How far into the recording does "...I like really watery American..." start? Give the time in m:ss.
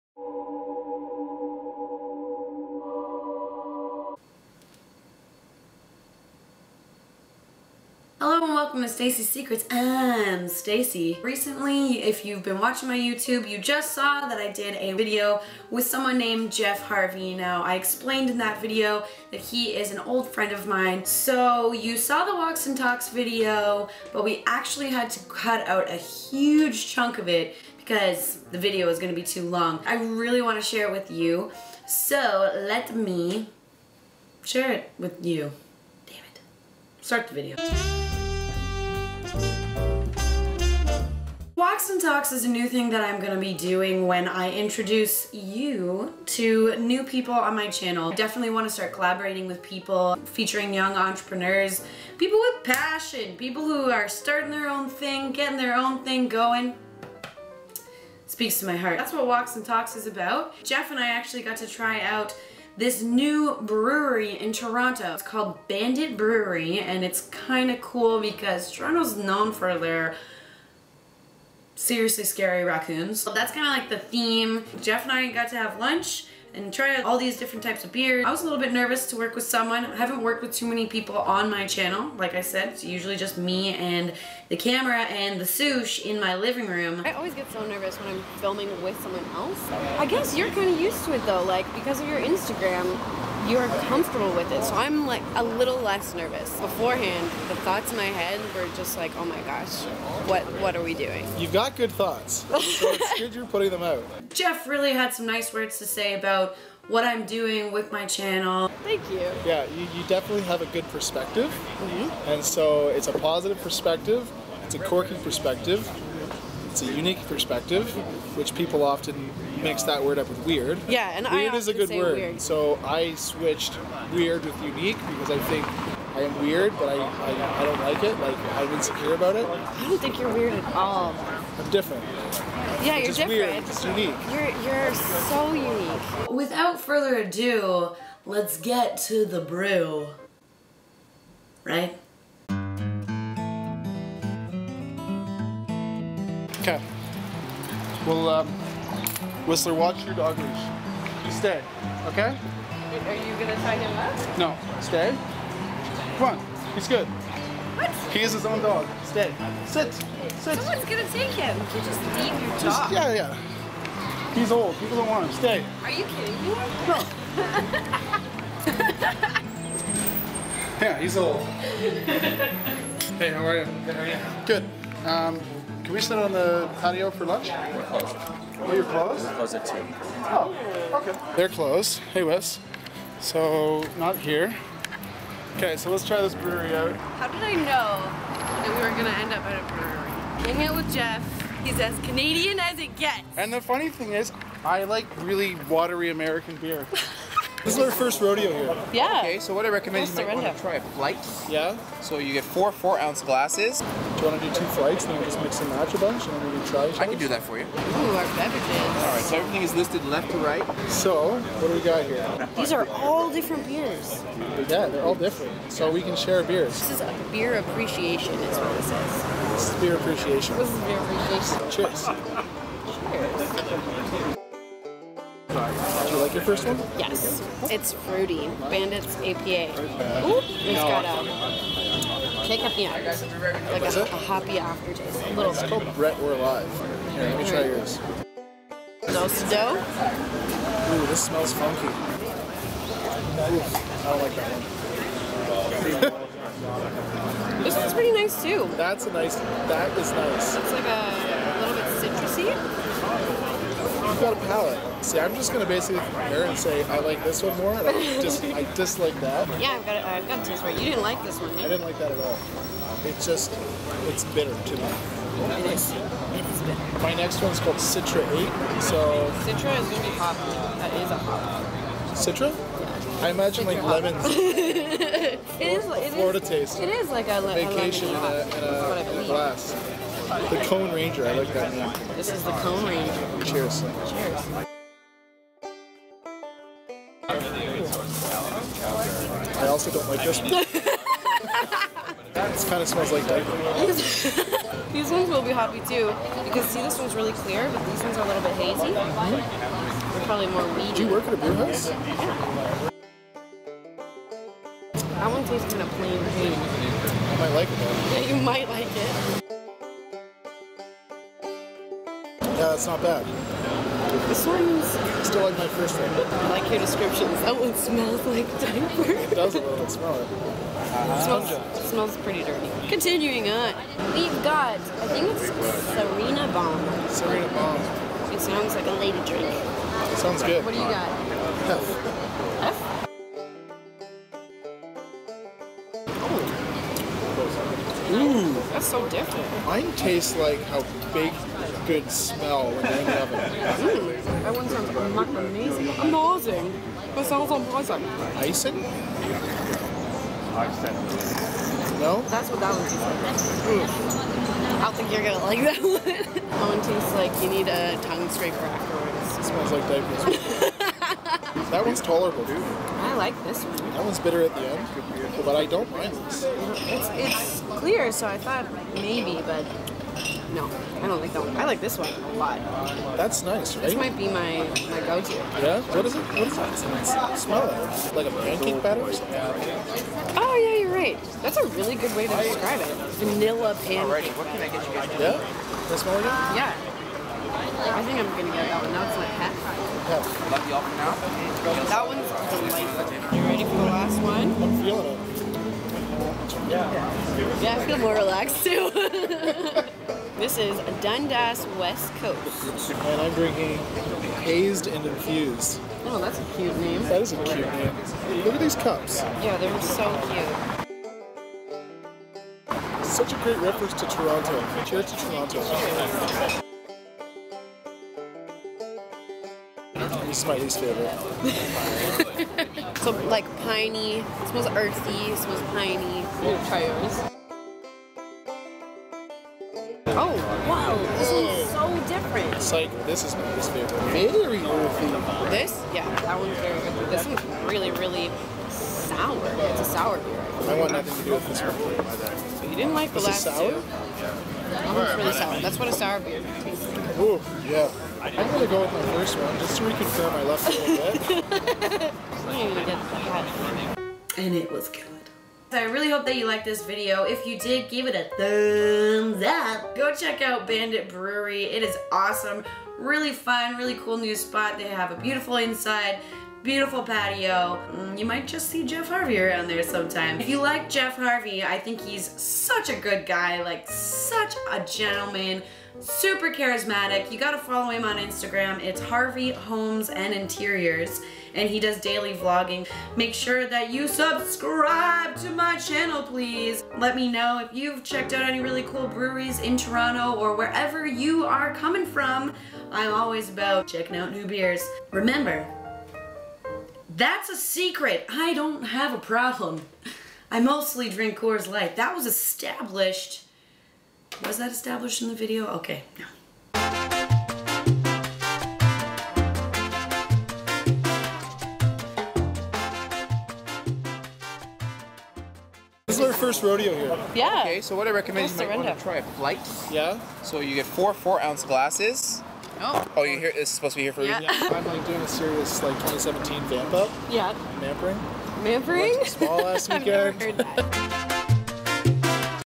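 3:14.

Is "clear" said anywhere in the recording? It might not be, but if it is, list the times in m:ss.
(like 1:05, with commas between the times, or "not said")
4:57, 6:07.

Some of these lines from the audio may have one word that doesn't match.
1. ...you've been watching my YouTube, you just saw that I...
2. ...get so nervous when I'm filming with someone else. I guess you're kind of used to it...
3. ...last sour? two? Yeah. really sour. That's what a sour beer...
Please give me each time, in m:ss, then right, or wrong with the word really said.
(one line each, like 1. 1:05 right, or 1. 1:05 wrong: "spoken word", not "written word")
1. 0:12 right
2. 1:27 right
3. 7:23 right.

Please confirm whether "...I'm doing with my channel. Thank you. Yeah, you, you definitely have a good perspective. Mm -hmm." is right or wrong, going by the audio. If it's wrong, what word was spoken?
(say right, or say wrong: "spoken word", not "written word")
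right.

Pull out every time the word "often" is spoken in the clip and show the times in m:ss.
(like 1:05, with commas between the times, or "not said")
1:58.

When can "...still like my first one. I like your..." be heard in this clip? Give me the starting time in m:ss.
5:15.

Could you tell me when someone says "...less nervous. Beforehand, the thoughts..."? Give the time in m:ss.
1:35.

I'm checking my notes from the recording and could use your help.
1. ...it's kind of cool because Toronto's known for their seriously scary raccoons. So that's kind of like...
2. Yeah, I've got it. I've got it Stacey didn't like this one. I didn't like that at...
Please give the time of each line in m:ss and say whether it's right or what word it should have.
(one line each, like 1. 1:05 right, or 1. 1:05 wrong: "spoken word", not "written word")
1. 1:07 right
2. 4:19 wrong: "You", not "Stacey".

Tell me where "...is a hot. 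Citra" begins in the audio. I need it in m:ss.
4:30.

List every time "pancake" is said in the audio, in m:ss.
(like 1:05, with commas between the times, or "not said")
6:18, 6:23.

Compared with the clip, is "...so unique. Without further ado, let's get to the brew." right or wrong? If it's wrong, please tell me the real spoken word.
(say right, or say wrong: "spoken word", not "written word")
right.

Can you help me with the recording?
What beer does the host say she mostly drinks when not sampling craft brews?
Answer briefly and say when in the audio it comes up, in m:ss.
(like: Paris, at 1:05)
Coors Light, at 8:21.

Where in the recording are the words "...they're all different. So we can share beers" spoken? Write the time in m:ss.
3:34.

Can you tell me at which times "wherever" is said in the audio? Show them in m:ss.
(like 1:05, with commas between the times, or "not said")
8:10.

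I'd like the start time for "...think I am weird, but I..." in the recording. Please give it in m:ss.
2:05.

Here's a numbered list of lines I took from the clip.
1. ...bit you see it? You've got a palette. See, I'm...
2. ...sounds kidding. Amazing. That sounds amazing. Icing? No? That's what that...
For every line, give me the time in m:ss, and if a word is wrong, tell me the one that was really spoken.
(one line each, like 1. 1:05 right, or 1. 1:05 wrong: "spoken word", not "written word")
1. 4:11 right
2. 5:44 wrong: "amazing", not "kidding".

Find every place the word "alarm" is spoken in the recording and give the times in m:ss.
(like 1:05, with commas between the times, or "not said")
not said.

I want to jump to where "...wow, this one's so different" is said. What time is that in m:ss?
7:10.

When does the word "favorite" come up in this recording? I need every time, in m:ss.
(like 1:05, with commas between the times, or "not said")
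7:00, 7:13.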